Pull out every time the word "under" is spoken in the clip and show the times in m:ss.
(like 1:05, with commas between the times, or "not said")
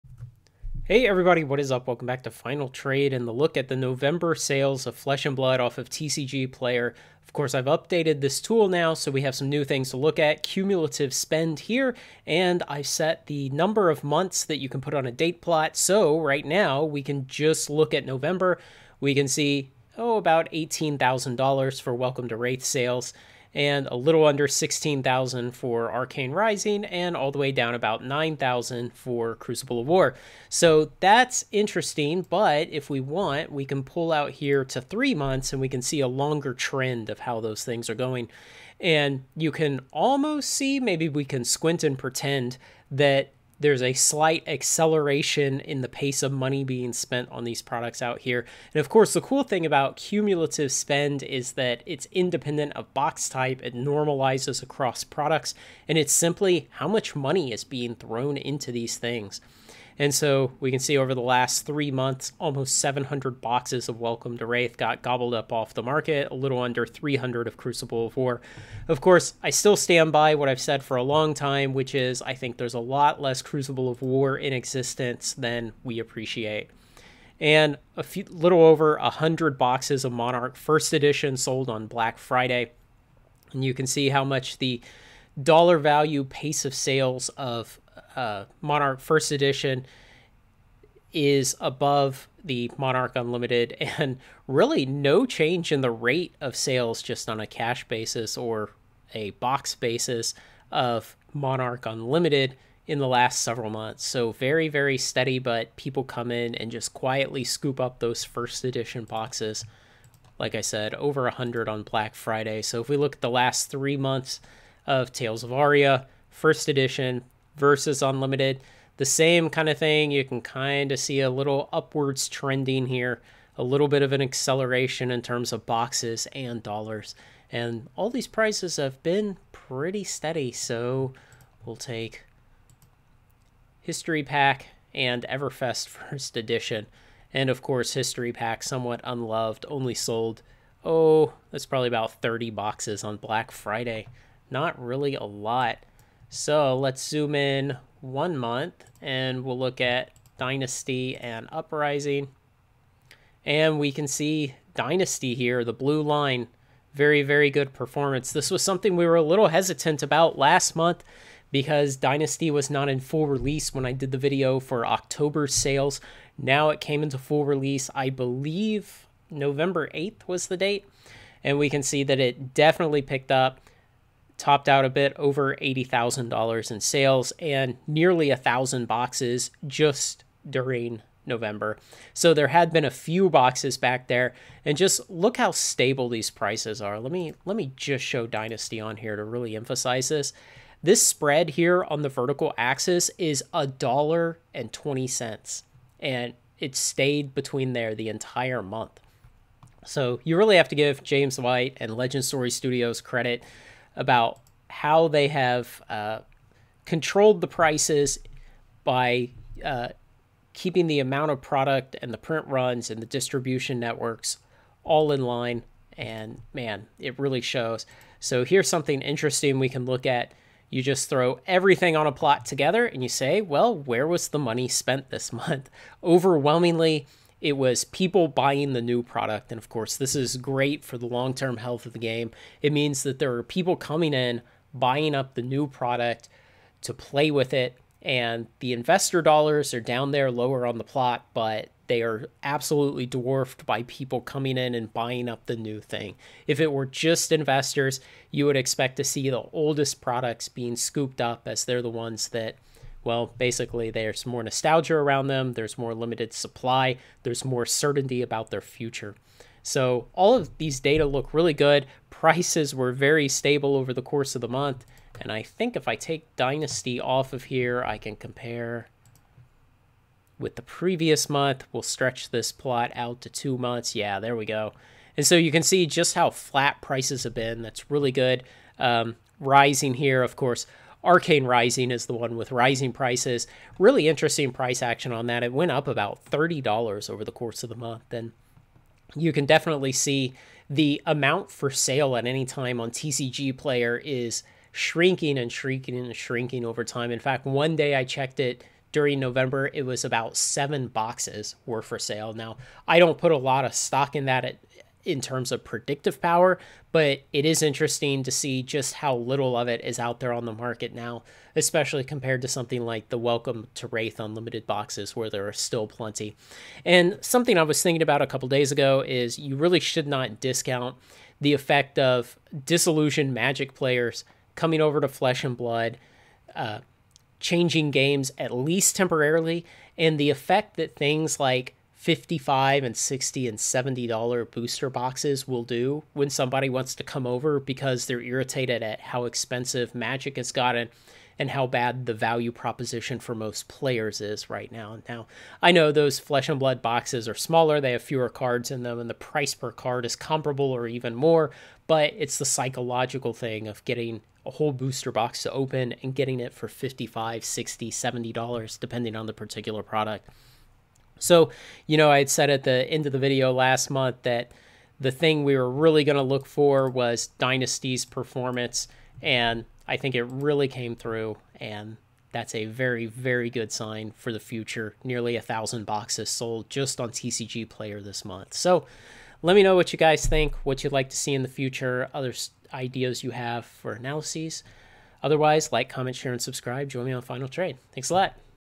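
0:24, 1:06.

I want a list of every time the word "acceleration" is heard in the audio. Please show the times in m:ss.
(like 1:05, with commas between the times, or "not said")
0:44, 2:04.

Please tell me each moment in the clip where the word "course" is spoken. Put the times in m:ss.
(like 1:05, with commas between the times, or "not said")
0:07, 0:48, 1:09, 2:17, 3:49, 4:24, 4:40, 4:47.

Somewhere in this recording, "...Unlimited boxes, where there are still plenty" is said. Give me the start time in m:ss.
5:14.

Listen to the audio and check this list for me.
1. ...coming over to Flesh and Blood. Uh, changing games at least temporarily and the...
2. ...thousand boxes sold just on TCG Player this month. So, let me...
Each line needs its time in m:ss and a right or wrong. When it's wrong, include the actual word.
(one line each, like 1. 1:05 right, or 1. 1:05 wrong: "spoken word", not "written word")
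1. 5:24 right
2. 6:15 right.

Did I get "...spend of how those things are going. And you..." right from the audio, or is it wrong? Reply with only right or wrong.
wrong.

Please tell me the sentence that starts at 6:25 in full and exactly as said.
Otherwise, like, comment, share, and subscribe.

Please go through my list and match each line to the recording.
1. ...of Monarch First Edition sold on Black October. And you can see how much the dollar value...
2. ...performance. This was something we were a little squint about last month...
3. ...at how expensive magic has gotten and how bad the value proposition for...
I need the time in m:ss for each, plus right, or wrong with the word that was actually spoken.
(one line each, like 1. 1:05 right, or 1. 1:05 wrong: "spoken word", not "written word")
1. 1:20 wrong: "Friday", not "October"
2. 2:37 wrong: "hesitant", not "squint"
3. 5:38 right.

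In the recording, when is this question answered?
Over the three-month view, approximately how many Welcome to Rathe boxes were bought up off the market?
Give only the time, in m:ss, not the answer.
1:02.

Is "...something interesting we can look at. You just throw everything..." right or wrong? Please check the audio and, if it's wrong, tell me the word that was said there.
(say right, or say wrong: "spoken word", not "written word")
right.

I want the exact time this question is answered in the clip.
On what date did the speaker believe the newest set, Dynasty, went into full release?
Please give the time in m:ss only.
2:49.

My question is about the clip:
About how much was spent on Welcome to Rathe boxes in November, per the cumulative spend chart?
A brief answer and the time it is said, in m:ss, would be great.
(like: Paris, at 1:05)
$18,000, at 0:20.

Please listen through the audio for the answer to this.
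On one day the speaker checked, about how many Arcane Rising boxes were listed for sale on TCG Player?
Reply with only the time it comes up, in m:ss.
5:00.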